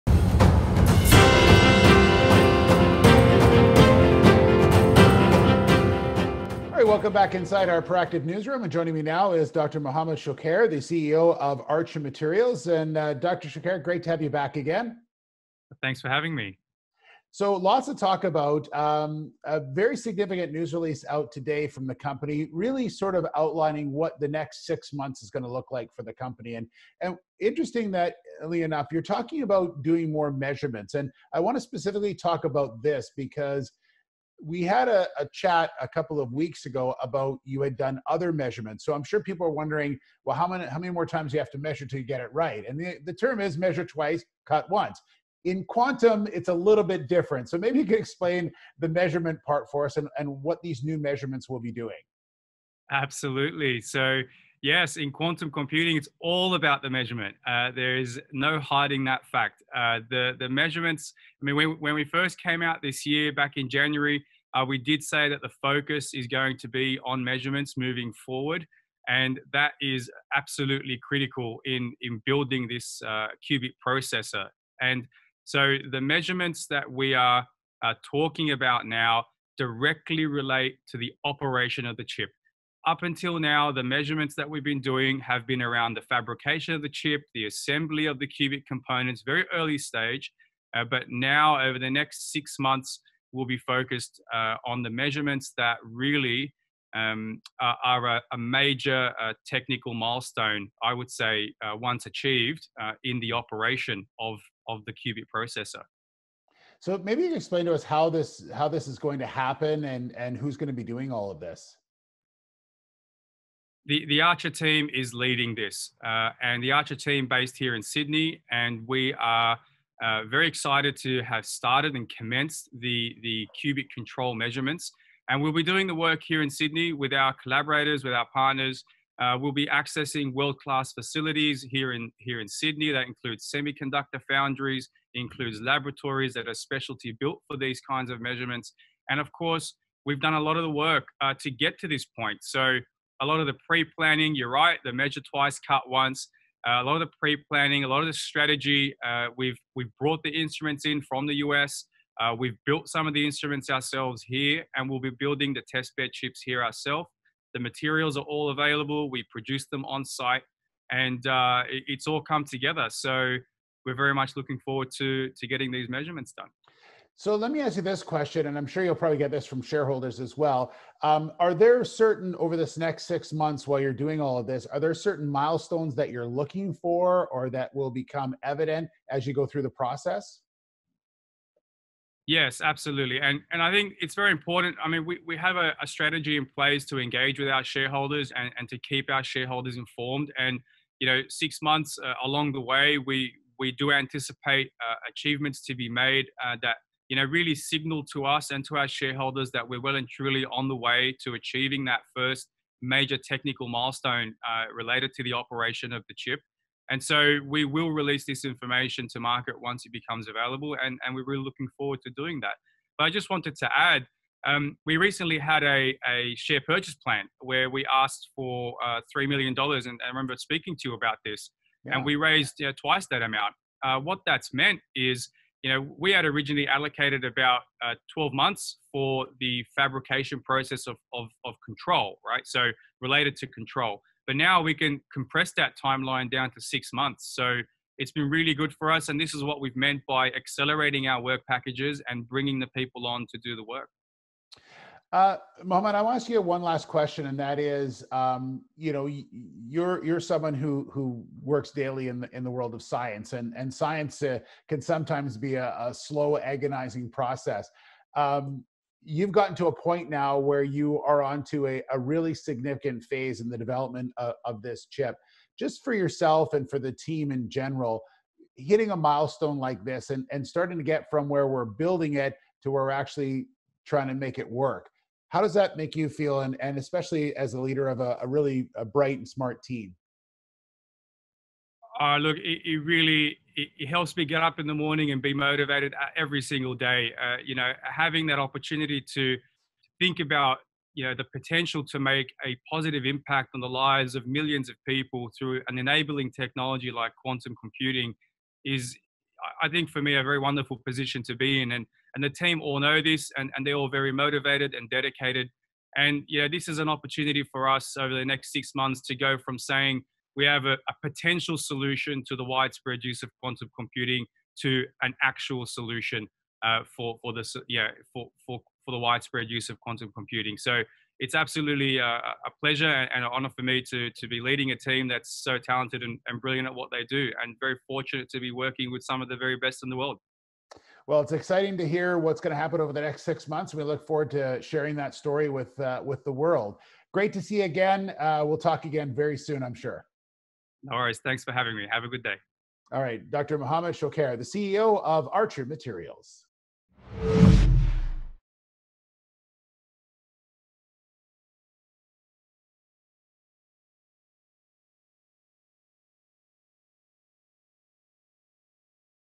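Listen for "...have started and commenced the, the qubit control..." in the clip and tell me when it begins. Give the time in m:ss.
2:01.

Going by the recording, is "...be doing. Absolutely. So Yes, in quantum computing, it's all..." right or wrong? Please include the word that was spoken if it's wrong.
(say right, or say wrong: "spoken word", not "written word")
right.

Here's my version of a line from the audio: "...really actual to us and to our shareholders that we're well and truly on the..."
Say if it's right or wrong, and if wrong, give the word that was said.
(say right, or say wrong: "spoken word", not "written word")
wrong: "signal", not "actual".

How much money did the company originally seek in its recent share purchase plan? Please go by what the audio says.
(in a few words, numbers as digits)
$3 million.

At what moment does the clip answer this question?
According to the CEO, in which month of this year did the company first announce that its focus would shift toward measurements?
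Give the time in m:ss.
1:03.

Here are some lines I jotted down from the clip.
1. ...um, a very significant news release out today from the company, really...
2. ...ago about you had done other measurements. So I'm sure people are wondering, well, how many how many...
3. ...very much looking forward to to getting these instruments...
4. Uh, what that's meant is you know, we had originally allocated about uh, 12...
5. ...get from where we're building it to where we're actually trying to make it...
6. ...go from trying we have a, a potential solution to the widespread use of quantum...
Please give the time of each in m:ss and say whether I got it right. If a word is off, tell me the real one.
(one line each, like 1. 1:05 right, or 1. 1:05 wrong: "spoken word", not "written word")
1. 0:18 right
2. 0:36 right
3. 2:43 wrong: "measurements", not "instruments"
4. 3:43 right
5. 4:30 right
6. 5:09 wrong: "saying", not "trying".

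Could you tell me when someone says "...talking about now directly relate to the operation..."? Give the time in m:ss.
1:18.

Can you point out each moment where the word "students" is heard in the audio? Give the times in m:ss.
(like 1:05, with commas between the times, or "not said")
not said.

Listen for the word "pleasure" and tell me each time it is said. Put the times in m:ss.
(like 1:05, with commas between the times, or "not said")
5:22.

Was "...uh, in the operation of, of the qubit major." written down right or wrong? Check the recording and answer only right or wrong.
wrong.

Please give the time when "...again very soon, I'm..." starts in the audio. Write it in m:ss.
5:38.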